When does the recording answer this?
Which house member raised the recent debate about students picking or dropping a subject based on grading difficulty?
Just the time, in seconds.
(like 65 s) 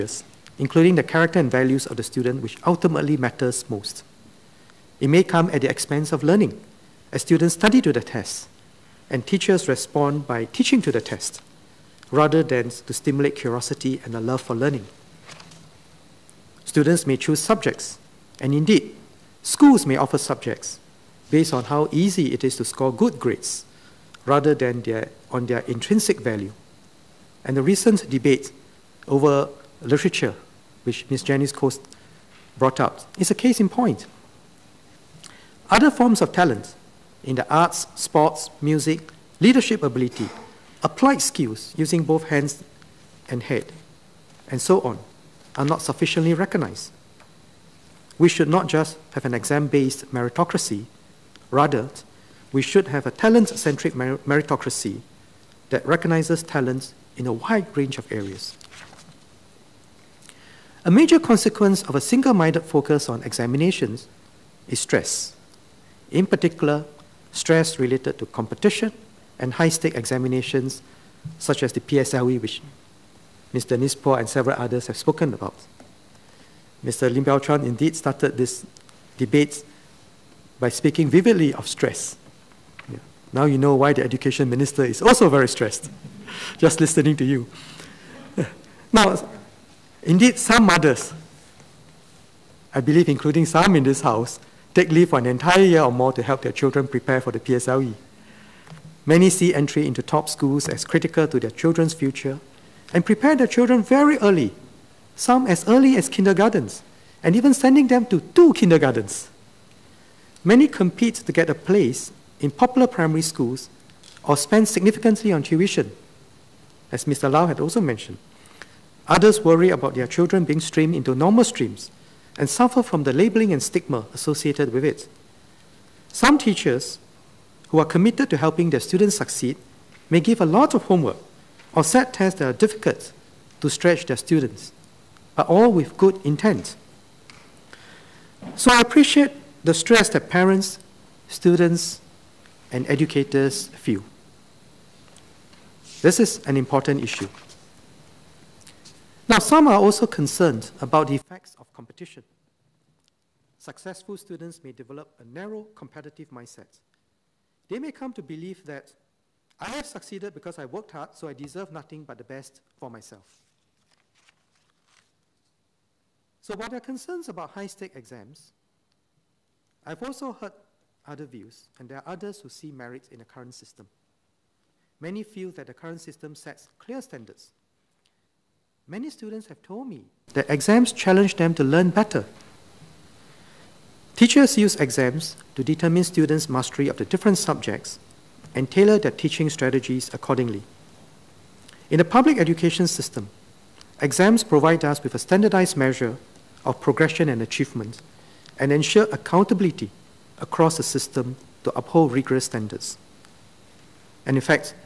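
31 s.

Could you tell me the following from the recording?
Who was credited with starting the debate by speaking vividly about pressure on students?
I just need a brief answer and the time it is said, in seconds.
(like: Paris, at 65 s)
Lim Biow Chuan, at 76 s.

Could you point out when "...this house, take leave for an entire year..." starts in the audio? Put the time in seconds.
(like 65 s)
93 s.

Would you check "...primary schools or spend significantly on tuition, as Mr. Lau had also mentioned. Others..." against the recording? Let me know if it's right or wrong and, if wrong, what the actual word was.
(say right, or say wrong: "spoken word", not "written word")
right.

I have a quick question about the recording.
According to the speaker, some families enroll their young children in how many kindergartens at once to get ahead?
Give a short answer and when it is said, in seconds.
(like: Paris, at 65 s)
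2, at 108 s.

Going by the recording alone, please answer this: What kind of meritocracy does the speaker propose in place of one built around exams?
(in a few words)
talent centric meritocracy.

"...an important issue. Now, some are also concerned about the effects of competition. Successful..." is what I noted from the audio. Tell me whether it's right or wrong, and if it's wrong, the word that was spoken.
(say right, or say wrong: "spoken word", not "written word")
right.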